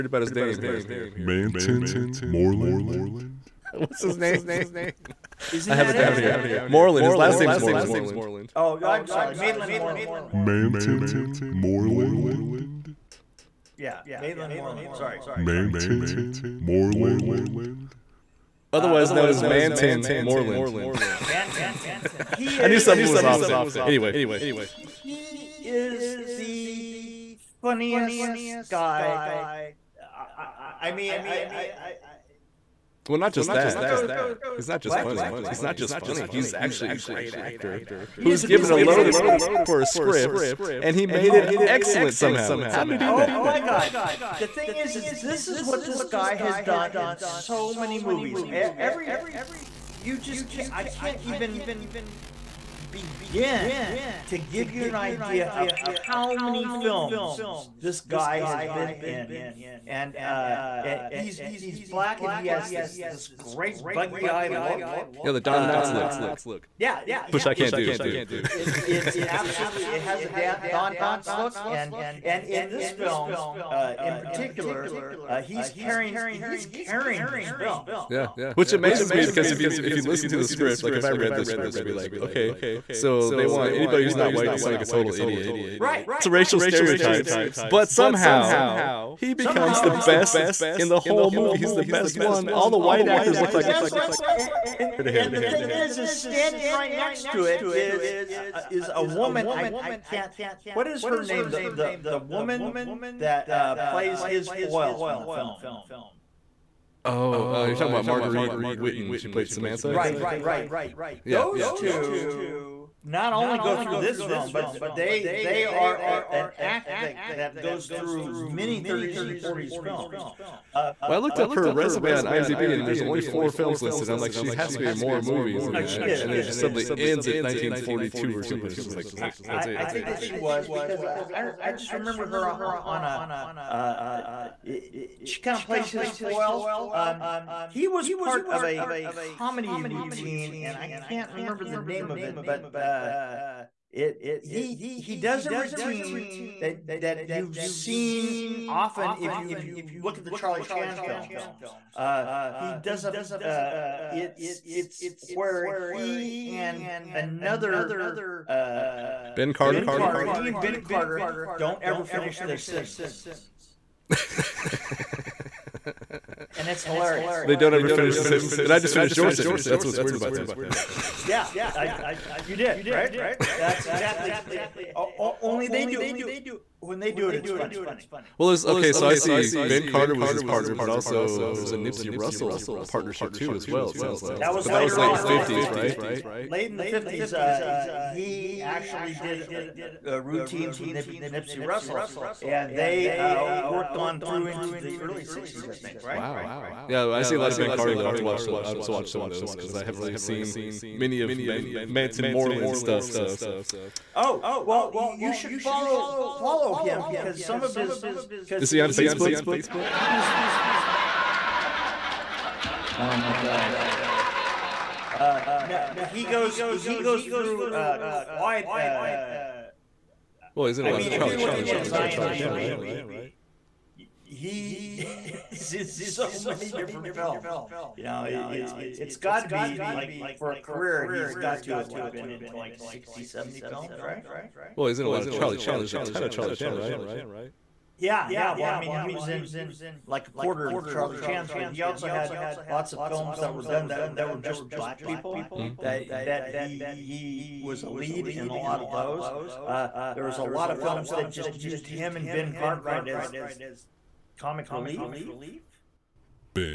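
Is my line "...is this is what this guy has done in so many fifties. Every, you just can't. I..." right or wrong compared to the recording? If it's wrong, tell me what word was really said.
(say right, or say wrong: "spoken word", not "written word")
wrong: "movies", not "fifties".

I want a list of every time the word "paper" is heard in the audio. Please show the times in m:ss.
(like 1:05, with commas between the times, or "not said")
not said.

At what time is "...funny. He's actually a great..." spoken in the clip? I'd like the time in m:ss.
0:35.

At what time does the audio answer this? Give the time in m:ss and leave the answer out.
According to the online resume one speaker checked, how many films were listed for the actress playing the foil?
2:03.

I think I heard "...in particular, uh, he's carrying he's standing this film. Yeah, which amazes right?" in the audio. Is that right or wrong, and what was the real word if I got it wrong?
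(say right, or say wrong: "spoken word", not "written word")
wrong: "carrying", not "standing".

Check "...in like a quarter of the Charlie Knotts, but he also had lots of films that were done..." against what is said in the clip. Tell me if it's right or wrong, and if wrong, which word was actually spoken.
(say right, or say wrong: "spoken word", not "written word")
wrong: "Chans", not "Knotts".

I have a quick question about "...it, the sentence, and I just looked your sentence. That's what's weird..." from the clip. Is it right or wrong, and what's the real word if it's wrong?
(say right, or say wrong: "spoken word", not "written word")
wrong: "finished", not "looked".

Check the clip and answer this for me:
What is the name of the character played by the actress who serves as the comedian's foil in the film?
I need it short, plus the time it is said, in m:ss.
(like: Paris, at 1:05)
Samantha, at 1:49.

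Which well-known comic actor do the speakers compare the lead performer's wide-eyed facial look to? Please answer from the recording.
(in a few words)
Don Knotts.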